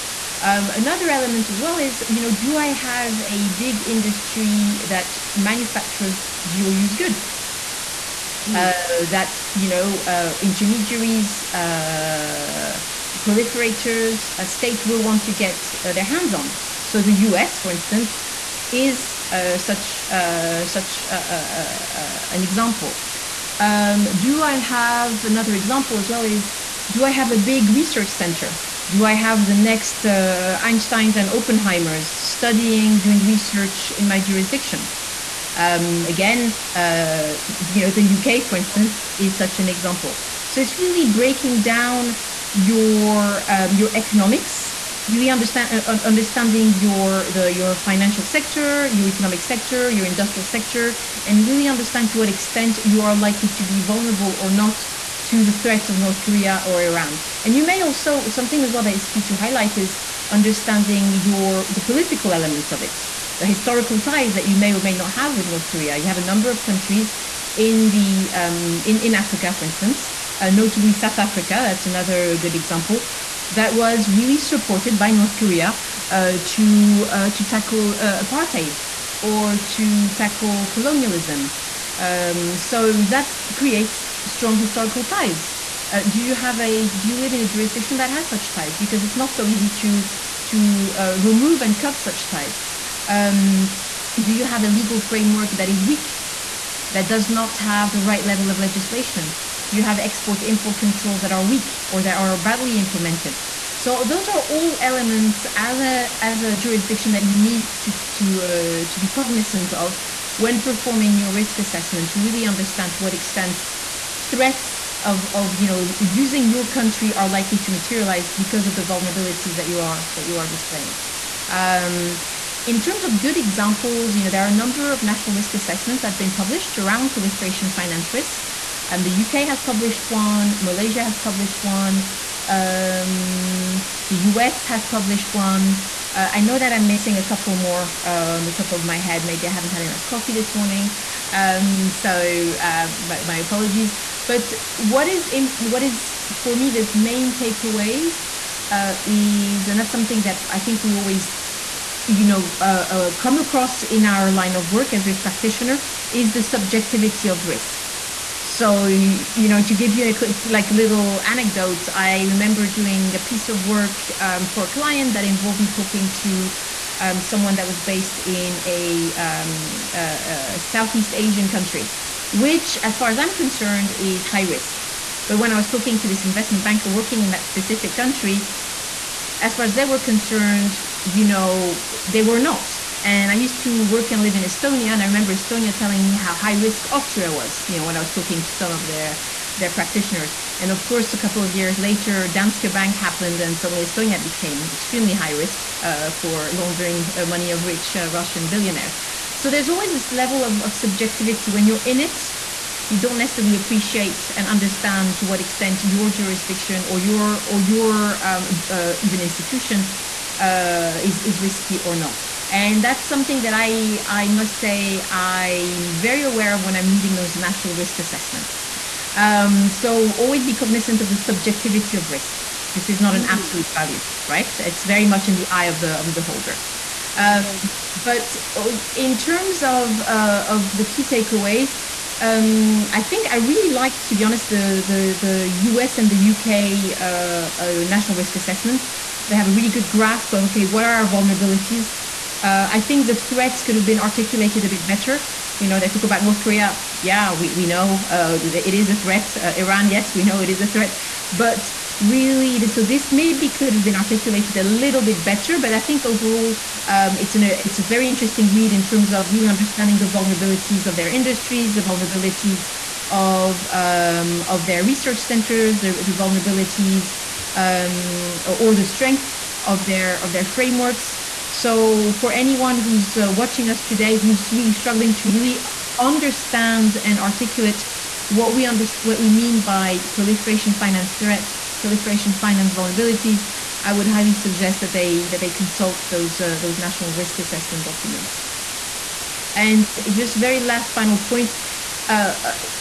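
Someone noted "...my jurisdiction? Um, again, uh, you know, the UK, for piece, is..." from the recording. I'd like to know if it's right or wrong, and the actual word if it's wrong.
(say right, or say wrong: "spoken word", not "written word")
wrong: "instance", not "piece".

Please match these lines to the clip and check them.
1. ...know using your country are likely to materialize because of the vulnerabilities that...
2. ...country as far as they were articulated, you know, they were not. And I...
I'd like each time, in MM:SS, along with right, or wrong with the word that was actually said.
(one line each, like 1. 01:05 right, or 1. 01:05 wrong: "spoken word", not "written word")
1. 01:55 right
2. 02:57 wrong: "concerned", not "articulated".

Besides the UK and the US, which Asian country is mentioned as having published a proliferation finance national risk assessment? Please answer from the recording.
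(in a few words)
Malaysia.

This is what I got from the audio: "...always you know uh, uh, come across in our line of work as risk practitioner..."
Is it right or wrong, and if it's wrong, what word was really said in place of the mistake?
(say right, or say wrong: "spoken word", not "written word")
right.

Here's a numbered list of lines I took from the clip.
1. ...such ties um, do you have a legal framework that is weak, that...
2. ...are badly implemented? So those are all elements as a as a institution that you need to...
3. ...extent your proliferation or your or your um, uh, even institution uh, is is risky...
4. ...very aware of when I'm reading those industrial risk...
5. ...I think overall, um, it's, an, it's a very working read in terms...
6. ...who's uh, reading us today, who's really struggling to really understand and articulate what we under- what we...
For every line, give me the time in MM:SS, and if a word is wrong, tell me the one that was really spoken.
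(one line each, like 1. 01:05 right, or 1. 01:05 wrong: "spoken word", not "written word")
1. 01:31 right
2. 01:42 wrong: "jurisdiction", not "institution"
3. 03:25 wrong: "jurisdiction", not "proliferation"
4. 03:35 wrong: "national", not "industrial"
5. 04:15 wrong: "interesting", not "working"
6. 04:32 wrong: "watching", not "reading".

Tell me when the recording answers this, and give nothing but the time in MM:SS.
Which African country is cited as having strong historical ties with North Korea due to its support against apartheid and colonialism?
01:10.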